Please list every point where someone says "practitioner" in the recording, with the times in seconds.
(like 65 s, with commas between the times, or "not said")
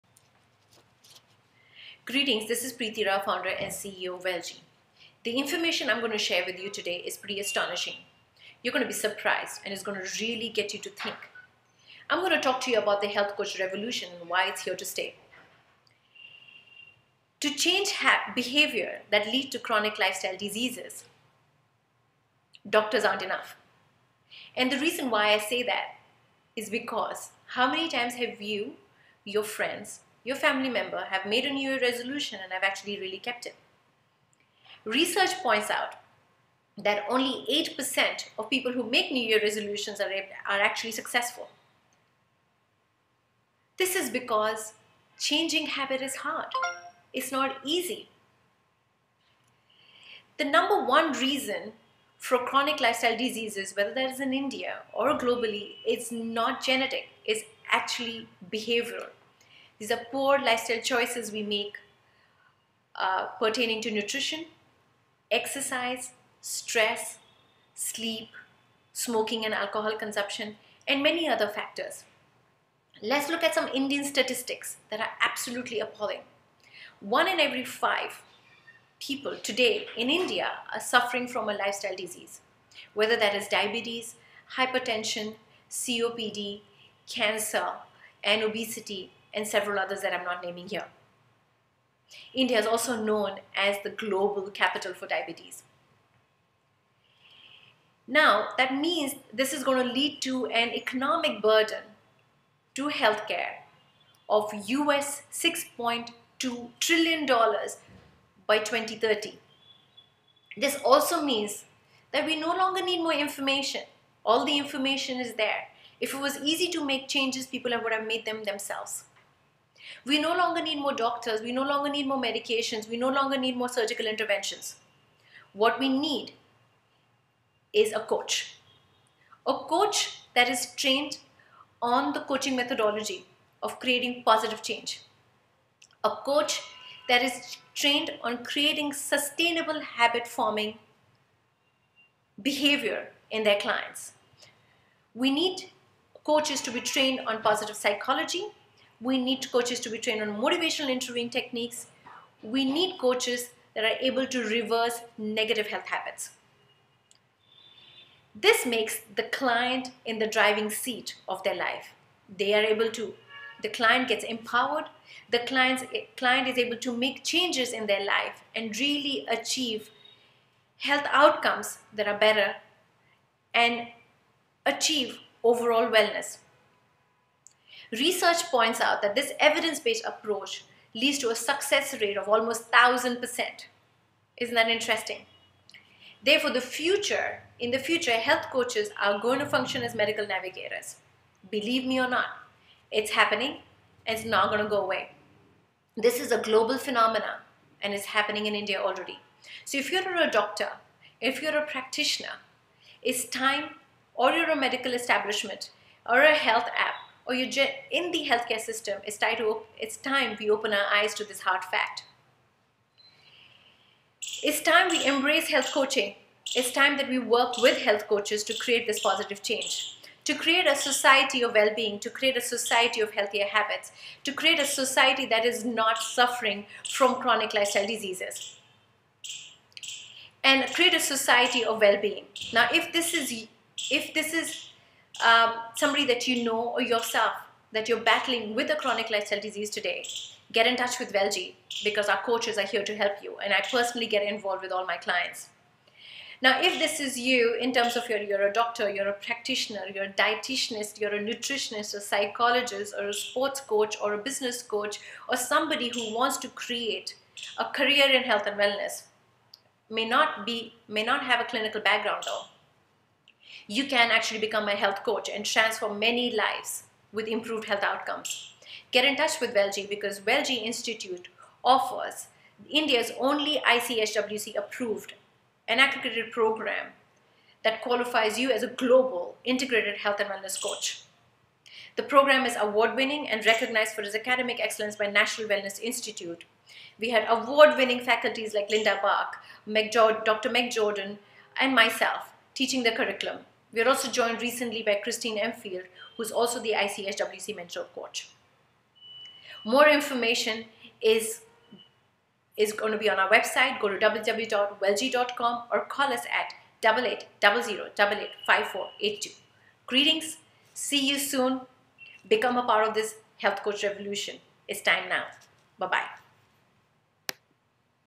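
201 s, 249 s.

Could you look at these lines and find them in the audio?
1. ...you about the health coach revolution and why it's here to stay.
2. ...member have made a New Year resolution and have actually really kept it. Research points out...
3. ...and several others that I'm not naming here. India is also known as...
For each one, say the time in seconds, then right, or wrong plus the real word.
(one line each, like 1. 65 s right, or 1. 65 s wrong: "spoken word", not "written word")
1. 12 s right
2. 30 s right
3. 89 s right.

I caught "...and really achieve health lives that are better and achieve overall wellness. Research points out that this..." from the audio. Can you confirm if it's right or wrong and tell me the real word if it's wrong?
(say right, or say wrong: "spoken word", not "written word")
wrong: "outcomes", not "lives".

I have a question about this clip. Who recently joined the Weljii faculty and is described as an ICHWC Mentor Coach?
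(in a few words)
Christine Emfield.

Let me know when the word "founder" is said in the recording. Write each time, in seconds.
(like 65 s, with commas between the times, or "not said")
3 s.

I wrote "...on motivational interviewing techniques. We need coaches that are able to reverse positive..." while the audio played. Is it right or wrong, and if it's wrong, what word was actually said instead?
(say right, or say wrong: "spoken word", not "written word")
wrong: "negative", not "positive".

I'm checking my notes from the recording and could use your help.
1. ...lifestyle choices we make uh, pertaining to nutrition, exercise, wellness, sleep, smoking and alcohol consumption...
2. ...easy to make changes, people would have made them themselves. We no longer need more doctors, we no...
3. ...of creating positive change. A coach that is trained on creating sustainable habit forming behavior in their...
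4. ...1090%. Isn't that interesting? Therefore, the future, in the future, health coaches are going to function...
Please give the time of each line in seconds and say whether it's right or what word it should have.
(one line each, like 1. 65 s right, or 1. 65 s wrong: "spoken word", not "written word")
1. 60 s wrong: "stress", not "wellness"
2. 116 s right
3. 133 s right
4. 182 s wrong: "1000", not "1090".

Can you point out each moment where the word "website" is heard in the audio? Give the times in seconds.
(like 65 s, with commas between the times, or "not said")
303 s.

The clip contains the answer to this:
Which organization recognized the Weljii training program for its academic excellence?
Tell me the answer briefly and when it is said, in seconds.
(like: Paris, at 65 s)
National Wellness Institute, at 285 s.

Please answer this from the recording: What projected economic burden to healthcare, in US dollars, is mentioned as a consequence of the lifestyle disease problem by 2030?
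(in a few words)
$6.2 trillion.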